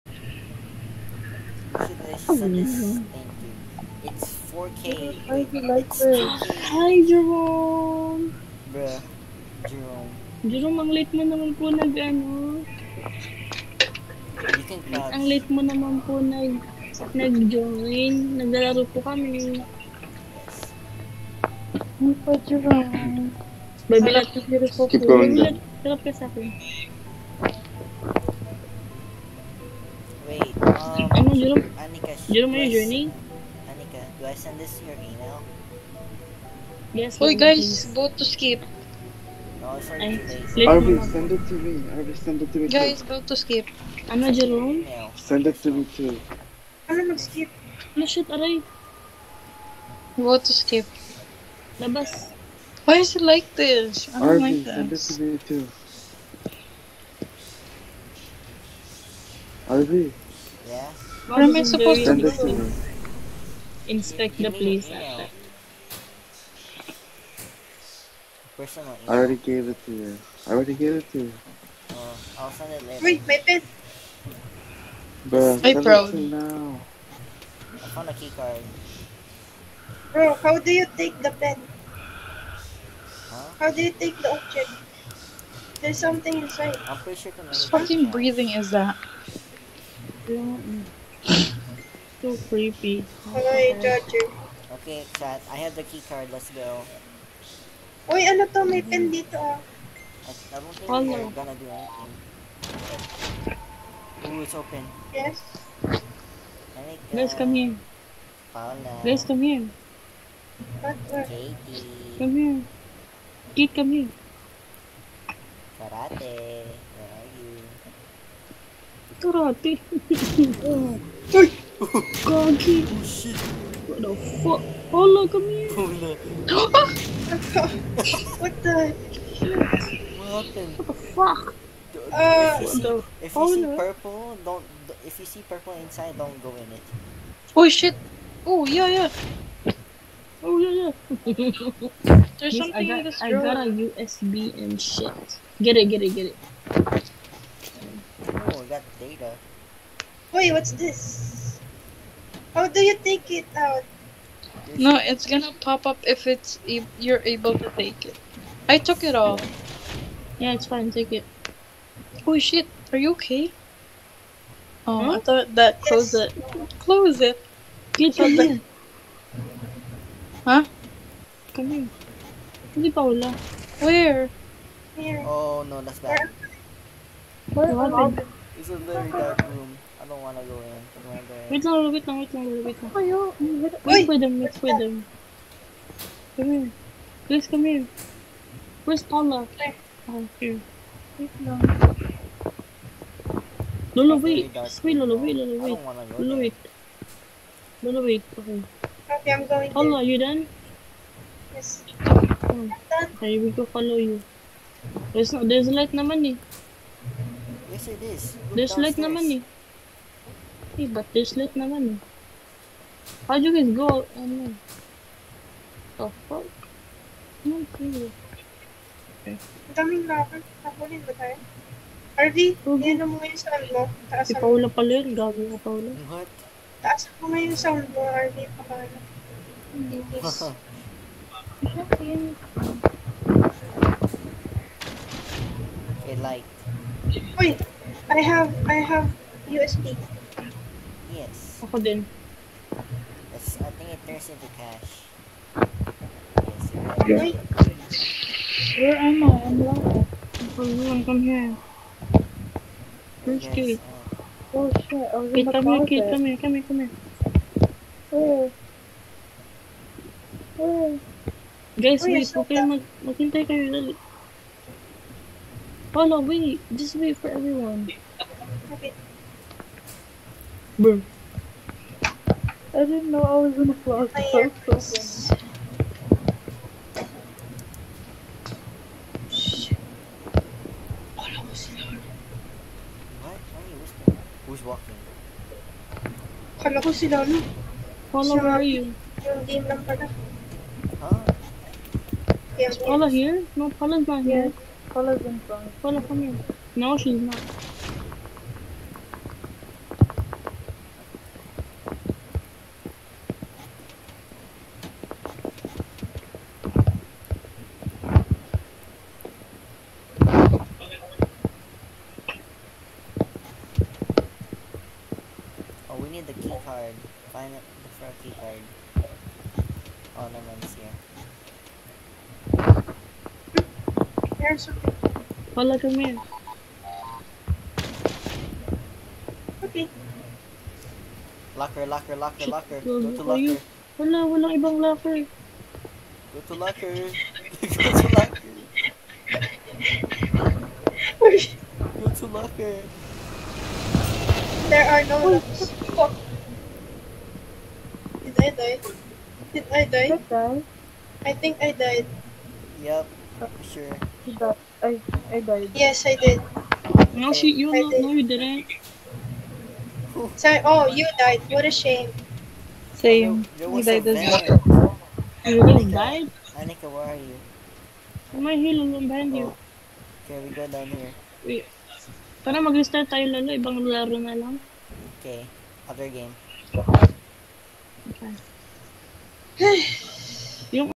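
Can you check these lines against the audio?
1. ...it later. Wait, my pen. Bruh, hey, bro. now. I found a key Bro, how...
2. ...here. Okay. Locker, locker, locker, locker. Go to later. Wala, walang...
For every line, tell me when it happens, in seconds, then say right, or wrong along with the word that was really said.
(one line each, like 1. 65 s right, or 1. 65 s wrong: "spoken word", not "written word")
1. 72 s right
2. 325 s wrong: "locker", not "later".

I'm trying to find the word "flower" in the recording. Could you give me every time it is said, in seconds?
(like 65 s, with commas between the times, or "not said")
273 s.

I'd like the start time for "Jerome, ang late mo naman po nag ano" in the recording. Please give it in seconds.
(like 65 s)
10 s.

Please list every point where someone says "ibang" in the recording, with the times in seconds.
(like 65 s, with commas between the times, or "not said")
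334 s, 373 s.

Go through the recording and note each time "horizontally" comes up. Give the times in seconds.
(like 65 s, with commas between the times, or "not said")
not said.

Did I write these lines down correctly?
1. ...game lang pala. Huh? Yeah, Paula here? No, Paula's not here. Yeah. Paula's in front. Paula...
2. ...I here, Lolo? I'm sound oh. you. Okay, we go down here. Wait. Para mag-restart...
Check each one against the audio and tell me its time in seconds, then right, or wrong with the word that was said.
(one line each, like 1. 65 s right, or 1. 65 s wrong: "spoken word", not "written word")
1. 289 s right
2. 368 s wrong: "behind", not "sound".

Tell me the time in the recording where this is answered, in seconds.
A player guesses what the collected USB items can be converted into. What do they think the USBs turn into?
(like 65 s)
244 s.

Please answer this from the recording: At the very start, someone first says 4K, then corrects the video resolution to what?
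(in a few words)
2K.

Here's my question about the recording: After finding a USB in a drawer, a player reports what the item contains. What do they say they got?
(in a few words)
data.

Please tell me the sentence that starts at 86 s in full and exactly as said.
I'm sure Whose fucking breathing is that?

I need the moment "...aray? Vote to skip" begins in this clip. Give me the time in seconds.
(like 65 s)
48 s.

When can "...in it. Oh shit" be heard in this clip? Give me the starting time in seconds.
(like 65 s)
136 s.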